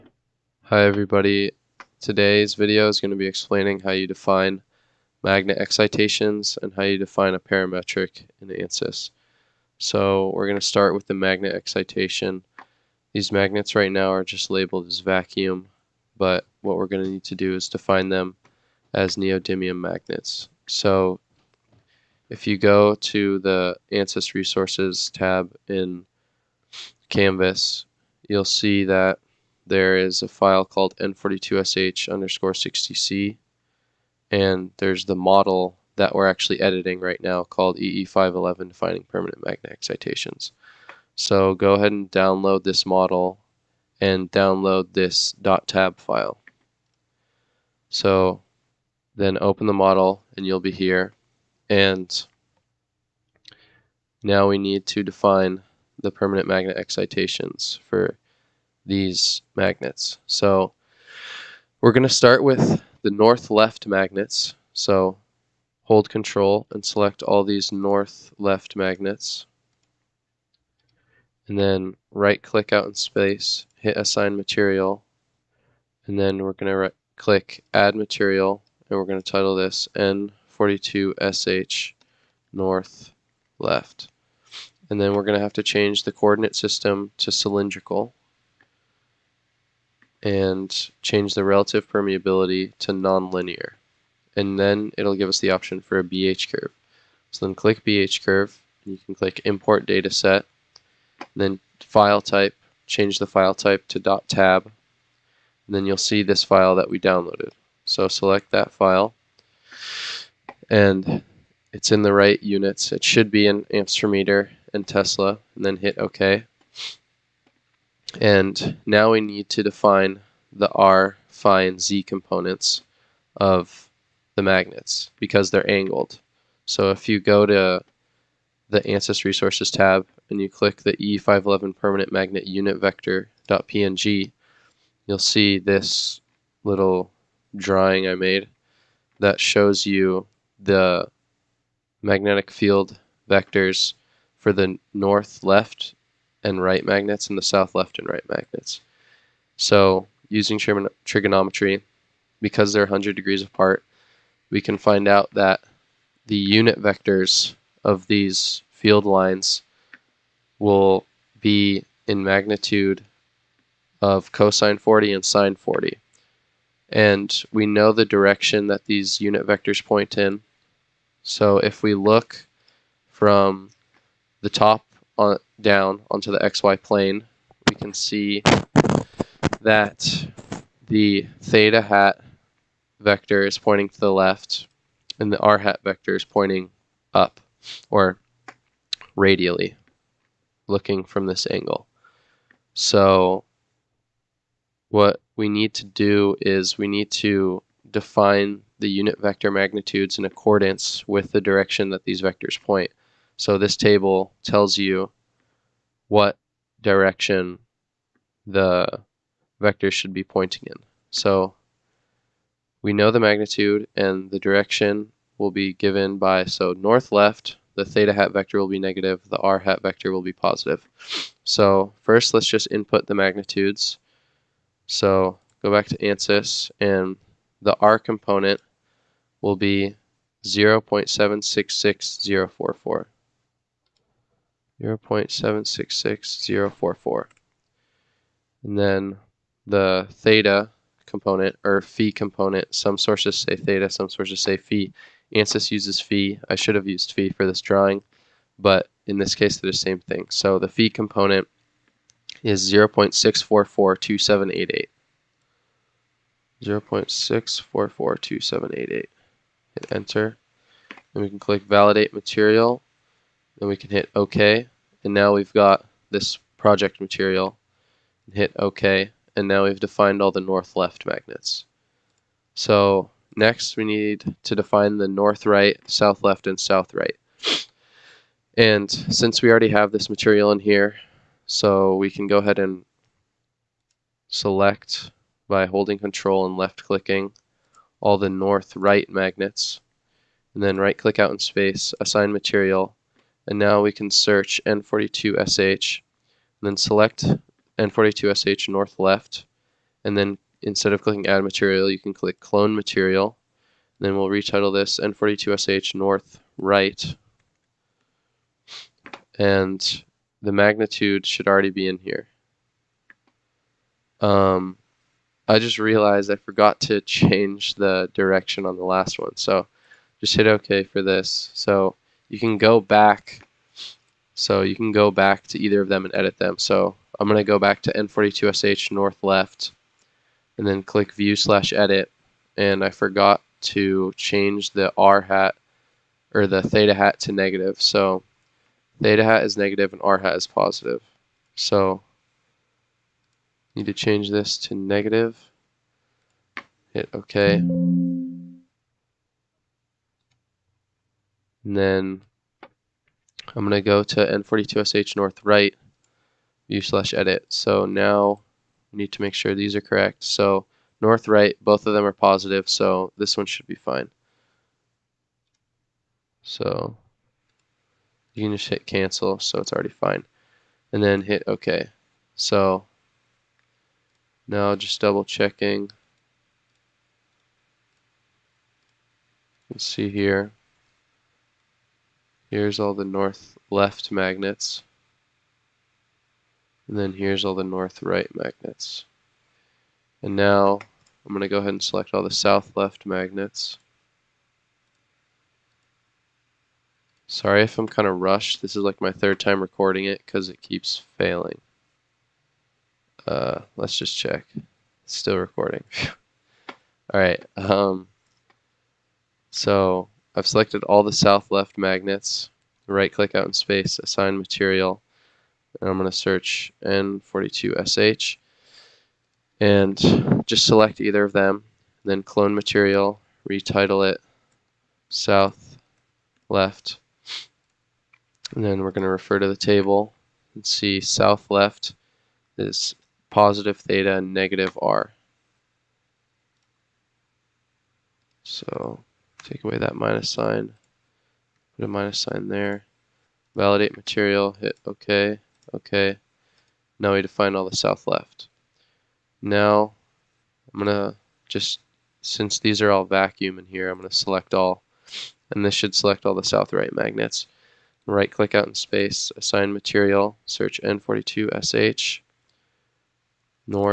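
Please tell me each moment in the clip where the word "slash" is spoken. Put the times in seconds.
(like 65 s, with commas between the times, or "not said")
331 s, 356 s.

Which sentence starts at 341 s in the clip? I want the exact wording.
So need to change this to negative.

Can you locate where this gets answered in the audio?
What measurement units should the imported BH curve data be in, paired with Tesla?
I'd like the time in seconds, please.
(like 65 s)
113 s.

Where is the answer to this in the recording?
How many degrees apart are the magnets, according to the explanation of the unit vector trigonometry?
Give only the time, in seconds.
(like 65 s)
152 s.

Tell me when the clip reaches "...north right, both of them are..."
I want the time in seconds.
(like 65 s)
361 s.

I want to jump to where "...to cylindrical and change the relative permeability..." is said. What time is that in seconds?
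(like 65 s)
87 s.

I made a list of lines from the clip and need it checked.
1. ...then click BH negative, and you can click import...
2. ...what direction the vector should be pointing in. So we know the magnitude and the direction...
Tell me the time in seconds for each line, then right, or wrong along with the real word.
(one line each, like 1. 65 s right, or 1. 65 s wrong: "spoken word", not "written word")
1. 97 s wrong: "curve", not "negative"
2. 206 s right.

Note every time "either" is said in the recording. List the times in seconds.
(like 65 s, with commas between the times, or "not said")
325 s, 421 s.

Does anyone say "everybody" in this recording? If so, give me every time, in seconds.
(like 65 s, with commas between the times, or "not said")
0 s.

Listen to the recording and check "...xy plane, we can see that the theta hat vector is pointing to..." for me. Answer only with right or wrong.
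right.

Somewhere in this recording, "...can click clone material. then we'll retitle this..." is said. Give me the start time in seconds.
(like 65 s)
301 s.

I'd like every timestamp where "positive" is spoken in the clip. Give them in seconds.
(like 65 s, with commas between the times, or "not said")
220 s, 340 s, 362 s, 433 s.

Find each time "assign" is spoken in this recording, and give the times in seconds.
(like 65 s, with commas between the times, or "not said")
73 s, 292 s, 414 s, 459 s.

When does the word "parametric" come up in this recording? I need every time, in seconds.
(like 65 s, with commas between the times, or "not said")
7 s.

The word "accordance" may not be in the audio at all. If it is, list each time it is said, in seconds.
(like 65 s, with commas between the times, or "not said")
200 s.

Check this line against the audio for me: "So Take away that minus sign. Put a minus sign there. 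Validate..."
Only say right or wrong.
right.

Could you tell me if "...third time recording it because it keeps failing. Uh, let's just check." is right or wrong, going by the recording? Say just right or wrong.
right.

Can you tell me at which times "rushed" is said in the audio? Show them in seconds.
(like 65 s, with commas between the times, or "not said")
398 s.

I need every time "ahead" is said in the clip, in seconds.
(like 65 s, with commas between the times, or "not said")
41 s, 282 s, 391 s.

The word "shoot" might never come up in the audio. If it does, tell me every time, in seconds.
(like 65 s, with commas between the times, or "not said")
not said.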